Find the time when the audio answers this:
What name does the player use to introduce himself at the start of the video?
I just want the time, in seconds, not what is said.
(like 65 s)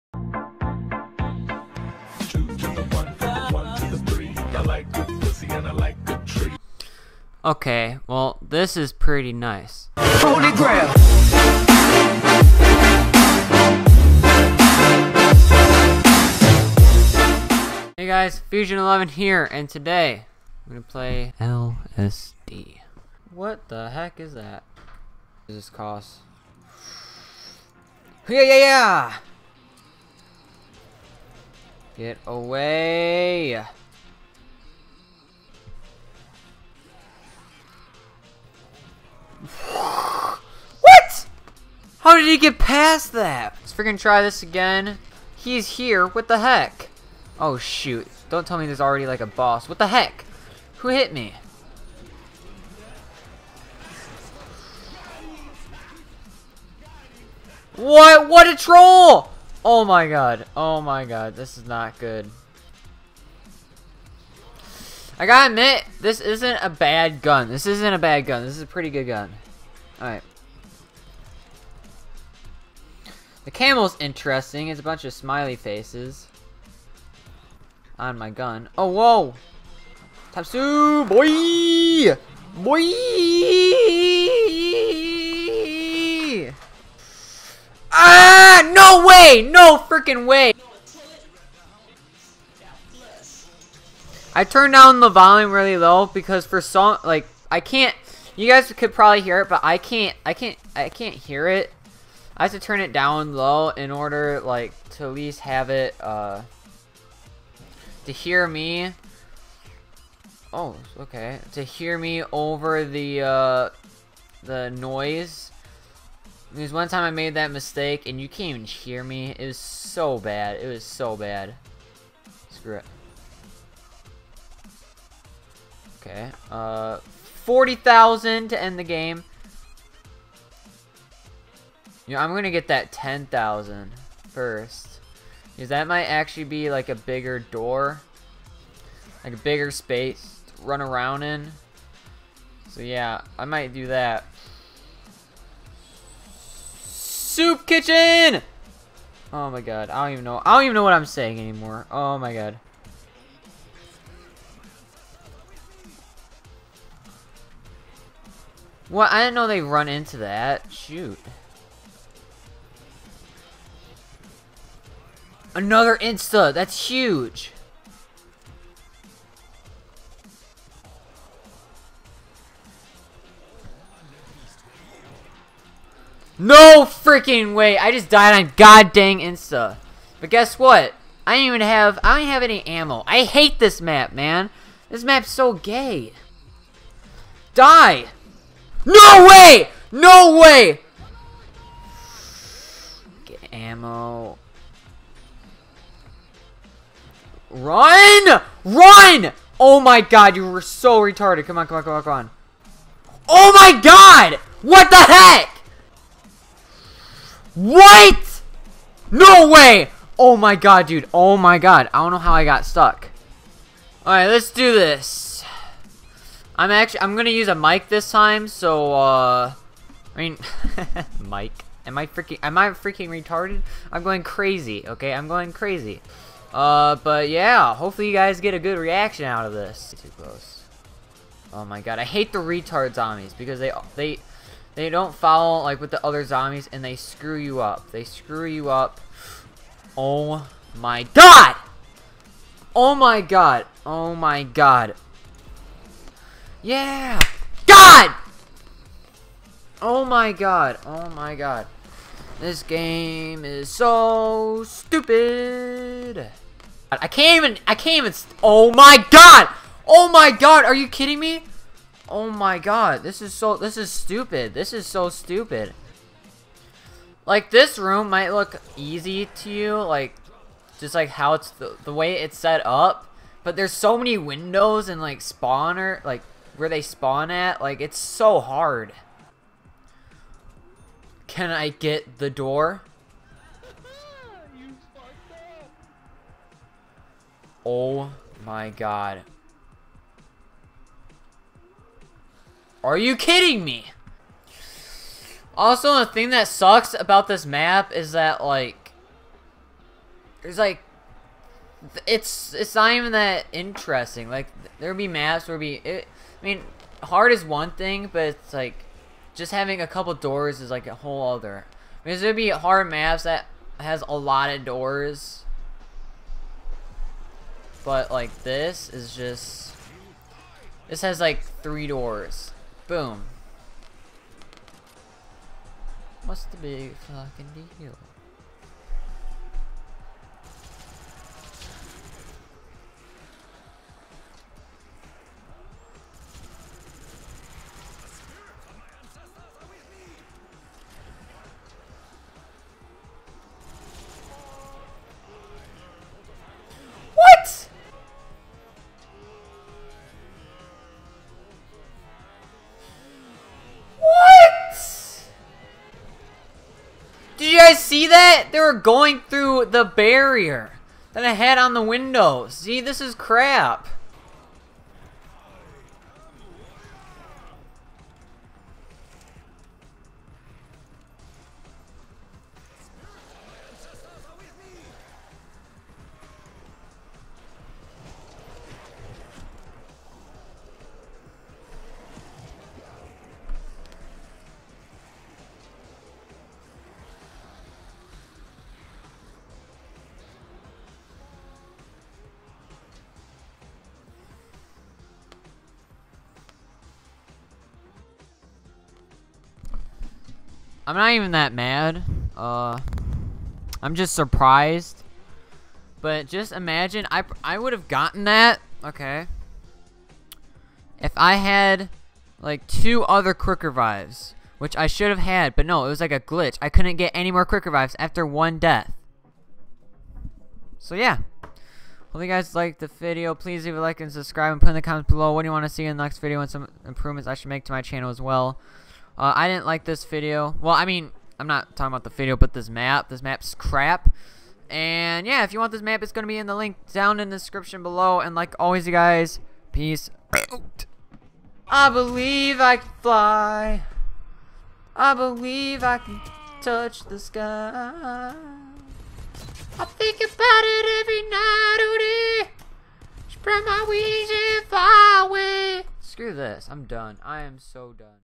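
18 s.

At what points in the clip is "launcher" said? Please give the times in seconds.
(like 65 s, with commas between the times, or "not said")
not said.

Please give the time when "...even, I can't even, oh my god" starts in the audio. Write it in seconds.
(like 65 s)
257 s.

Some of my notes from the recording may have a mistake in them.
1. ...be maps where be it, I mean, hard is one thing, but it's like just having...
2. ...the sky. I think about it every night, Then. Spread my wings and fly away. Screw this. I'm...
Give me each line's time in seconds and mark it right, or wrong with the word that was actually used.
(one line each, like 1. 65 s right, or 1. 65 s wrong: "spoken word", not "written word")
1. 304 s right
2. 447 s wrong: "Odie", not "Then".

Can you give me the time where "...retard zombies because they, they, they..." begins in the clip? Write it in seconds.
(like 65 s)
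232 s.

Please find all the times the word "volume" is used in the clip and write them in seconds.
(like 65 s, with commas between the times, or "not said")
95 s.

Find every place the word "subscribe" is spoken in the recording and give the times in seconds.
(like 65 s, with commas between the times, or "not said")
424 s.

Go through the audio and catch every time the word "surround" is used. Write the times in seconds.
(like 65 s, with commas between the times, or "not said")
not said.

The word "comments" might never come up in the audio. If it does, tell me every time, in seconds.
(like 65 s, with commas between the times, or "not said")
424 s.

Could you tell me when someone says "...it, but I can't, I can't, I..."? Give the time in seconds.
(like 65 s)
99 s.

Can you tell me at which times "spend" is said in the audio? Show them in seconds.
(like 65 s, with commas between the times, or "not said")
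not said.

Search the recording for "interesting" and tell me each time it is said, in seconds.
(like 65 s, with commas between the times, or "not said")
73 s, 303 s.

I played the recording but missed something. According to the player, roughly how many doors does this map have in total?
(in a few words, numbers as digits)
three.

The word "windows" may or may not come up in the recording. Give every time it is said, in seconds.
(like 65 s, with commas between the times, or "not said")
274 s, 361 s.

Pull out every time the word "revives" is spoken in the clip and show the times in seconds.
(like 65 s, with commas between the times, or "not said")
413 s, 417 s.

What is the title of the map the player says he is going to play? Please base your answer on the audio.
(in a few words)
LSD.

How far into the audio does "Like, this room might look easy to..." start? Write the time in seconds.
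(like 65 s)
267 s.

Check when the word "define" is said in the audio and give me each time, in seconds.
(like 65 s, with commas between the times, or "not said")
not said.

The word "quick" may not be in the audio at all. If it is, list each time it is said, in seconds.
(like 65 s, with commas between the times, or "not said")
413 s, 417 s.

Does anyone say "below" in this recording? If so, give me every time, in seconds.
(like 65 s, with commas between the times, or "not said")
425 s, 437 s.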